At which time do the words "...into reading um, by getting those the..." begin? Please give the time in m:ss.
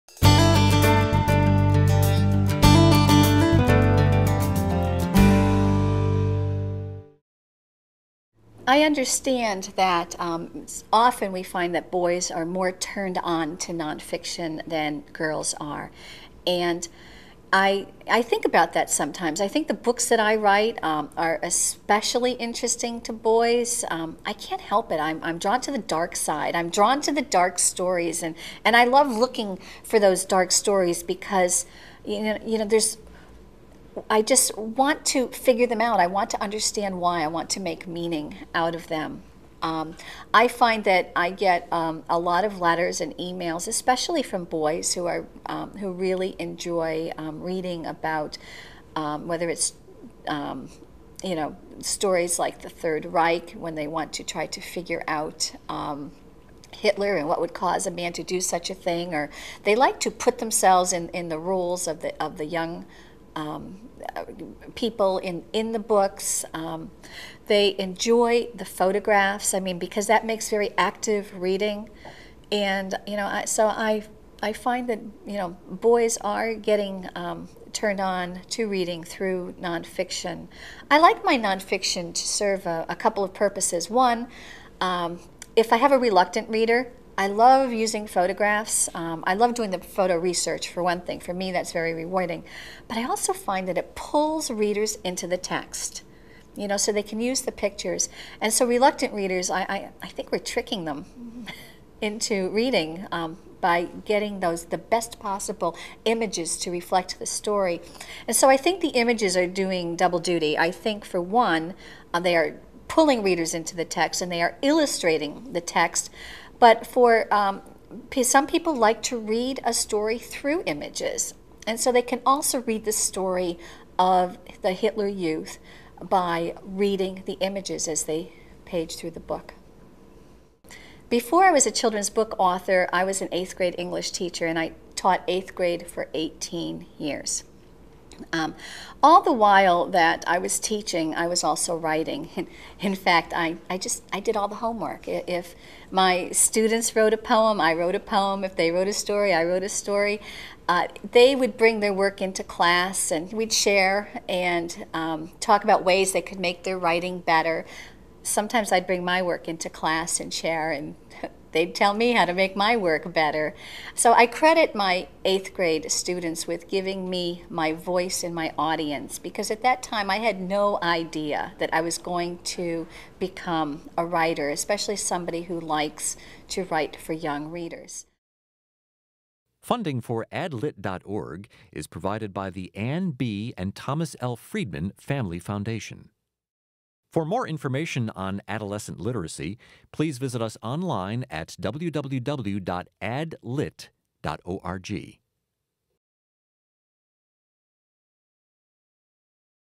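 1:42.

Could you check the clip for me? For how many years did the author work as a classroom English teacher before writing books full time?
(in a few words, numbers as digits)
18.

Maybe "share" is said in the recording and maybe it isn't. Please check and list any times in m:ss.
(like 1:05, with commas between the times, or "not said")
2:33, 2:40.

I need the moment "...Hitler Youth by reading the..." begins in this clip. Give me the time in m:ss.
2:04.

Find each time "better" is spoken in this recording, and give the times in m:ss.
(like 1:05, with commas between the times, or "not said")
2:37, 2:43.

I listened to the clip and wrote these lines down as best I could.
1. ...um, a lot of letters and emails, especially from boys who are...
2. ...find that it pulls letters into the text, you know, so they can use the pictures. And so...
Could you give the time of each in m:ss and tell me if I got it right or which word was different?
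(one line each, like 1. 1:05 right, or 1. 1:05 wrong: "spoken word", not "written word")
1. 0:41 right
2. 1:33 wrong: "readers", not "letters".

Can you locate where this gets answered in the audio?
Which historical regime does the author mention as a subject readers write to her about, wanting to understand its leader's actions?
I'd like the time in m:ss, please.
0:52.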